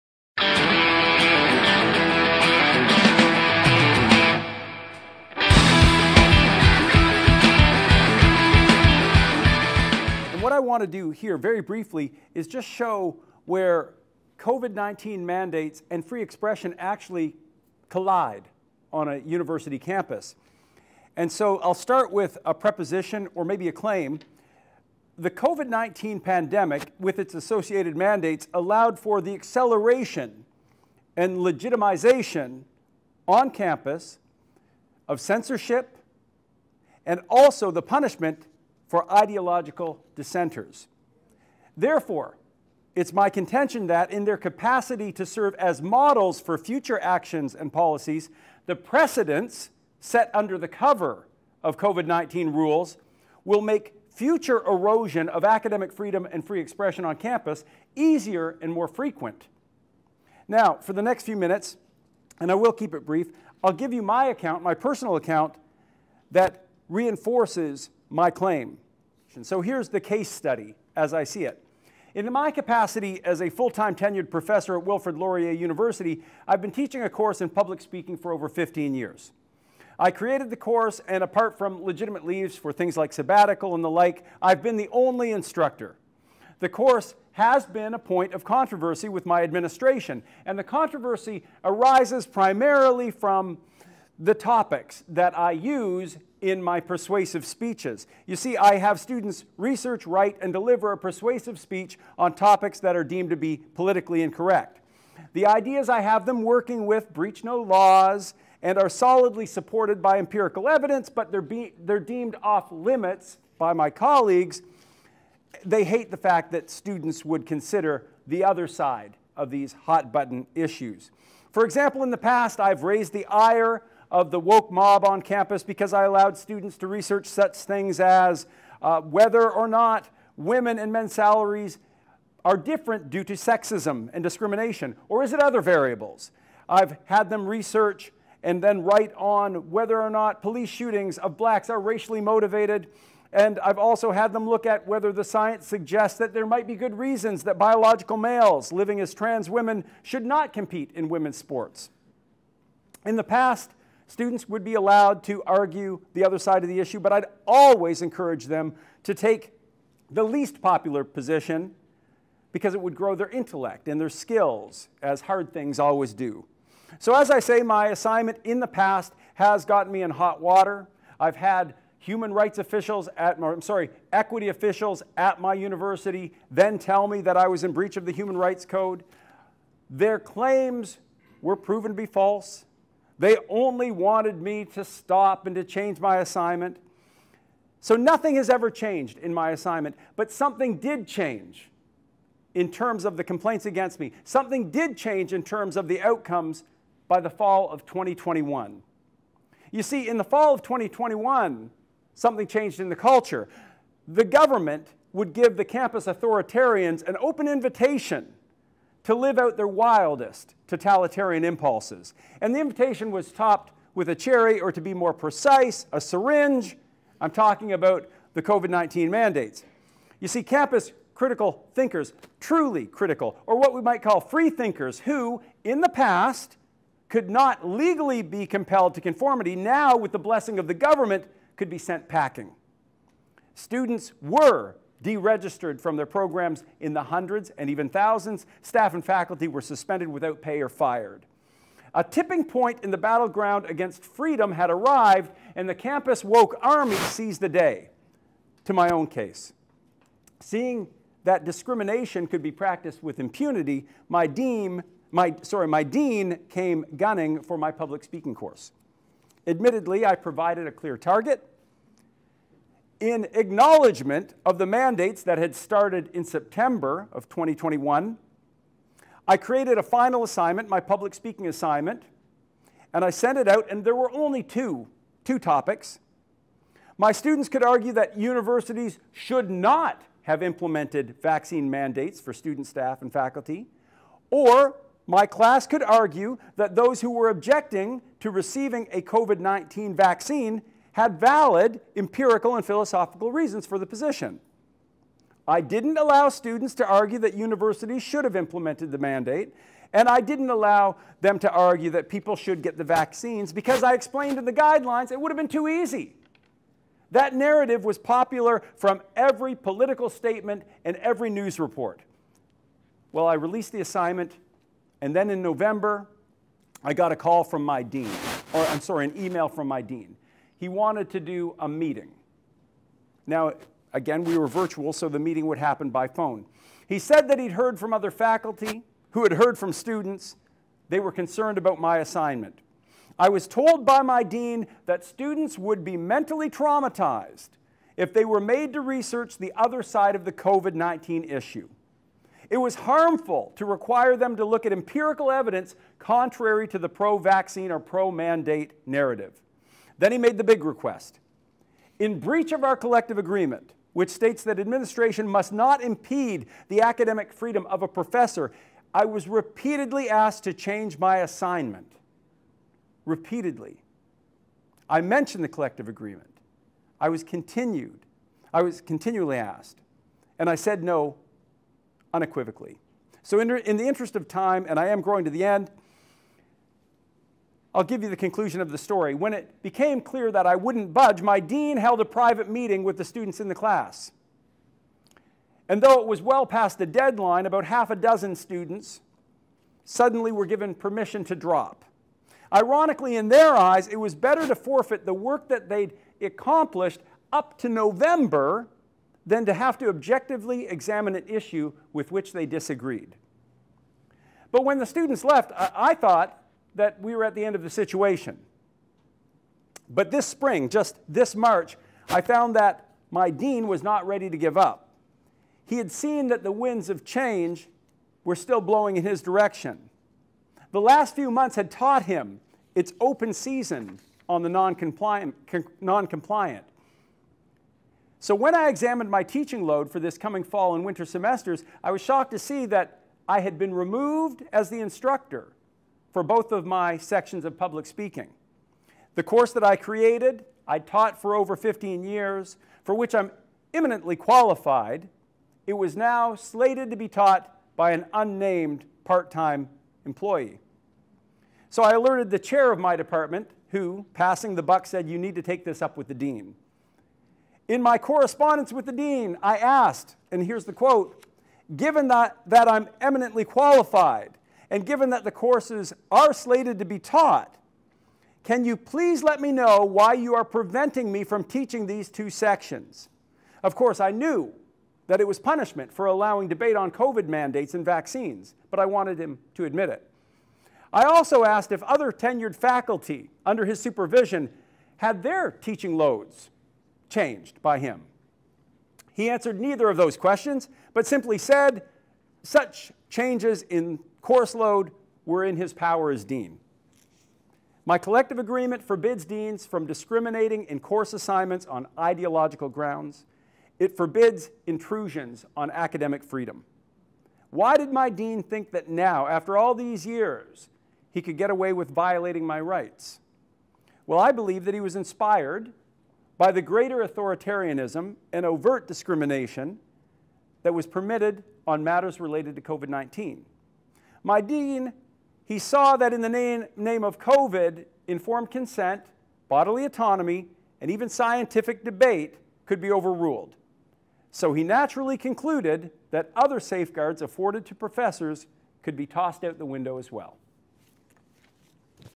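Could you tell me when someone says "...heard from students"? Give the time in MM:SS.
05:29.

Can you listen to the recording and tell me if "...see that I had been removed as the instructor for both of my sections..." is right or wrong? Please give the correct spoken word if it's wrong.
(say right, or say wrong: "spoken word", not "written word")
right.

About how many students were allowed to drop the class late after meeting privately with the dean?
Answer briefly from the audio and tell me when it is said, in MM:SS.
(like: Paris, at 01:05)
about half a dozen, at 06:27.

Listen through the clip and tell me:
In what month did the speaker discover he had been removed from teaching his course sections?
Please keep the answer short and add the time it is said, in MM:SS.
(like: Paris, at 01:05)
March, at 06:51.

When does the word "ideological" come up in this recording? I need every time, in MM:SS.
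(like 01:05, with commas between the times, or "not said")
00:39, 08:21.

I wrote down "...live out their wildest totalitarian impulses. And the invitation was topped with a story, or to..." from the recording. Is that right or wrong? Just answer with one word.
wrong.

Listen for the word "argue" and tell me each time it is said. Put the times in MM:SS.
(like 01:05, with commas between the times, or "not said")
02:35, 04:37, 04:45, 04:56, 05:01.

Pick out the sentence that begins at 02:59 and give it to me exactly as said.
Their claims were proven to be false.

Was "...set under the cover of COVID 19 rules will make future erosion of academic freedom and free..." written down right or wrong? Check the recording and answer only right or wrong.
right.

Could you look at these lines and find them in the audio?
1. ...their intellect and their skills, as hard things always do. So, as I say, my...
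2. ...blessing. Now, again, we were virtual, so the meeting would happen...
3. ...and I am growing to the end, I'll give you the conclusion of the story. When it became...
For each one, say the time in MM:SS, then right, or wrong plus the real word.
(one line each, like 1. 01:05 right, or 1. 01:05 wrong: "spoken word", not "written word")
1. 02:43 right
2. 05:21 wrong: "meeting", not "blessing"
3. 06:14 right.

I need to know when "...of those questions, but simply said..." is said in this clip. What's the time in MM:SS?
08:09.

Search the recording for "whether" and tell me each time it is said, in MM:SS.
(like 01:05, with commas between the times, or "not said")
02:09, 02:19, 02:24.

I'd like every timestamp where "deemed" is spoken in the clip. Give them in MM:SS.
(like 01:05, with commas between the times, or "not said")
01:43, 01:51.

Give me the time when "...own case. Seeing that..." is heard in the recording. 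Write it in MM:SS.
04:08.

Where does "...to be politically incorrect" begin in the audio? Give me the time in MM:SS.
01:43.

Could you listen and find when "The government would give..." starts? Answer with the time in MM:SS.
03:24.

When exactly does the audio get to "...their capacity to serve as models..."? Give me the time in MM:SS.
00:44.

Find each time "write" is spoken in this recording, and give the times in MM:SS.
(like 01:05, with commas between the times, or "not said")
01:40, 02:18.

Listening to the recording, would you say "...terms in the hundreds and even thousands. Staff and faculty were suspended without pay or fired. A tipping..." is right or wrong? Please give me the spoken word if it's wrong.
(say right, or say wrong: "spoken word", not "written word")
wrong: "programs", not "terms".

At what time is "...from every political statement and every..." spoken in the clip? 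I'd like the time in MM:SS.
05:08.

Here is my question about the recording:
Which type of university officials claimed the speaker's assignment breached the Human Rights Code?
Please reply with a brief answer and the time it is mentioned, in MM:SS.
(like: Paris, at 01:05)
equity officials, at 02:54.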